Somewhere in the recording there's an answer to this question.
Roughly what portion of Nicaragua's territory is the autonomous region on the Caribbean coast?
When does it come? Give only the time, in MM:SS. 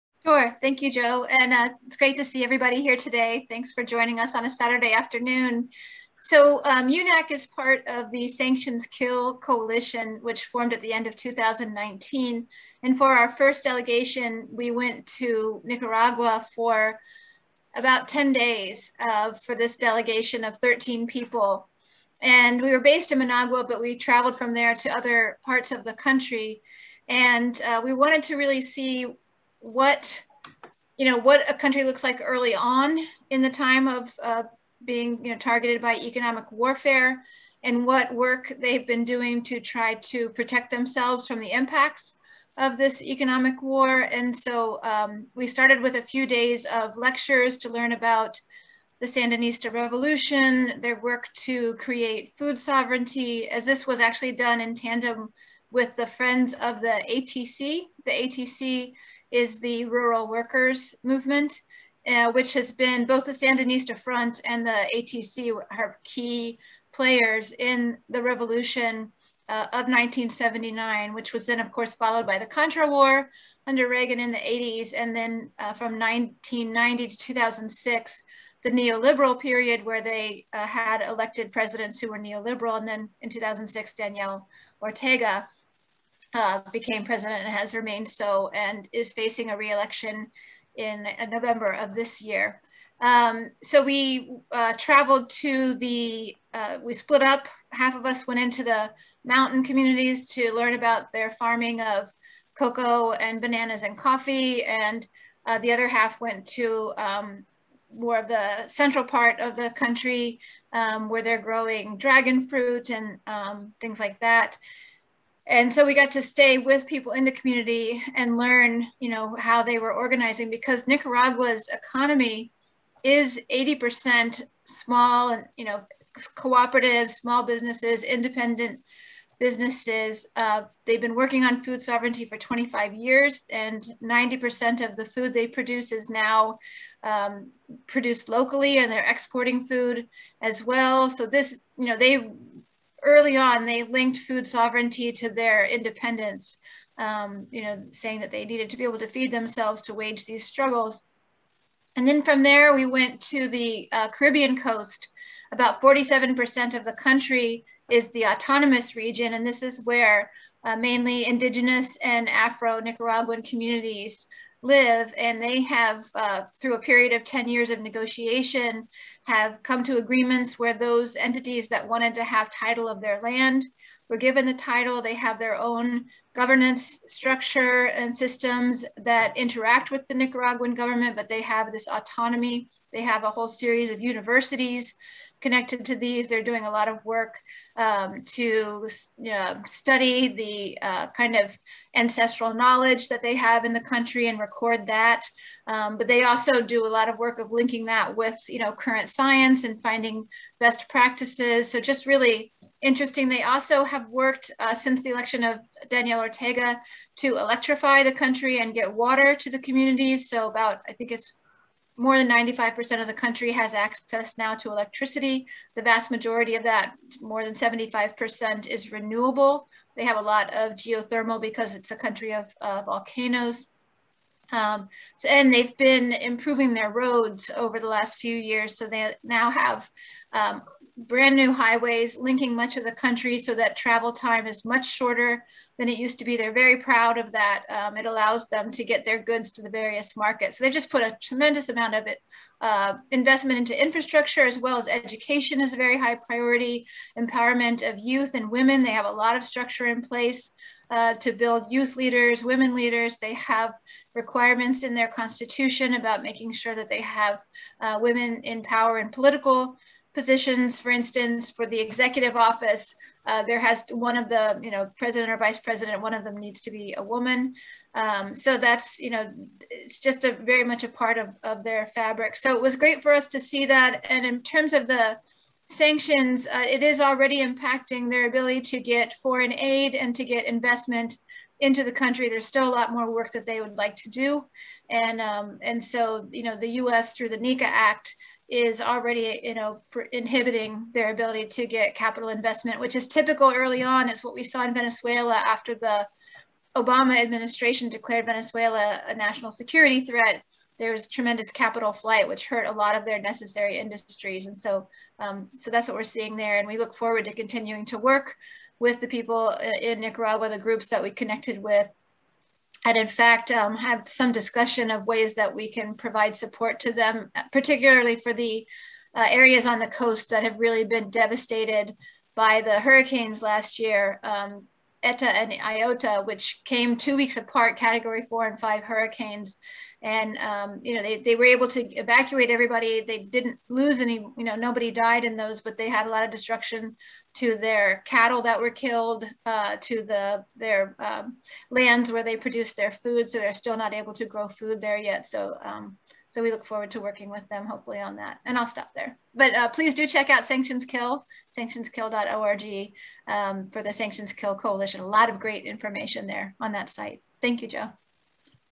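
02:35.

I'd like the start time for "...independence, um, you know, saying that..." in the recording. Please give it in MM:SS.
02:25.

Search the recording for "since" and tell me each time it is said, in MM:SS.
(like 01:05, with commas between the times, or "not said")
03:24.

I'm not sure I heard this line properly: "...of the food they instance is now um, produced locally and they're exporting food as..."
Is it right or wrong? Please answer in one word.
wrong.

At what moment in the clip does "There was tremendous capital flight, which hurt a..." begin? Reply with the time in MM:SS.
05:00.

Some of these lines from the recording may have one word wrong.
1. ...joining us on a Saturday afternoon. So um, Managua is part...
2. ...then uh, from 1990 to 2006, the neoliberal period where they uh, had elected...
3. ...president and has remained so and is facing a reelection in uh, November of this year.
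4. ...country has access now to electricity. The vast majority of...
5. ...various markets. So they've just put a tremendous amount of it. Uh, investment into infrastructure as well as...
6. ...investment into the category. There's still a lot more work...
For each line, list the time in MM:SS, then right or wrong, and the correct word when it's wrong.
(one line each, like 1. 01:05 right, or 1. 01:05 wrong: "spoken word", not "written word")
1. 00:03 wrong: "UNAC", not "Managua"
2. 01:15 right
3. 01:27 right
4. 03:33 right
5. 03:59 right
6. 04:40 wrong: "country", not "category".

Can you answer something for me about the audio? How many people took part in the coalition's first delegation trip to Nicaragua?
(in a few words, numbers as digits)
13.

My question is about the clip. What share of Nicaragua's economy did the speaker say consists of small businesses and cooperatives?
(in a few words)
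80%.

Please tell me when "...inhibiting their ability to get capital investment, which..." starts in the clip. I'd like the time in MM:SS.
04:50.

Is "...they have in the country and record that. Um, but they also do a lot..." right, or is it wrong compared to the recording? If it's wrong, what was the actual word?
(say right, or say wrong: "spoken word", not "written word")
right.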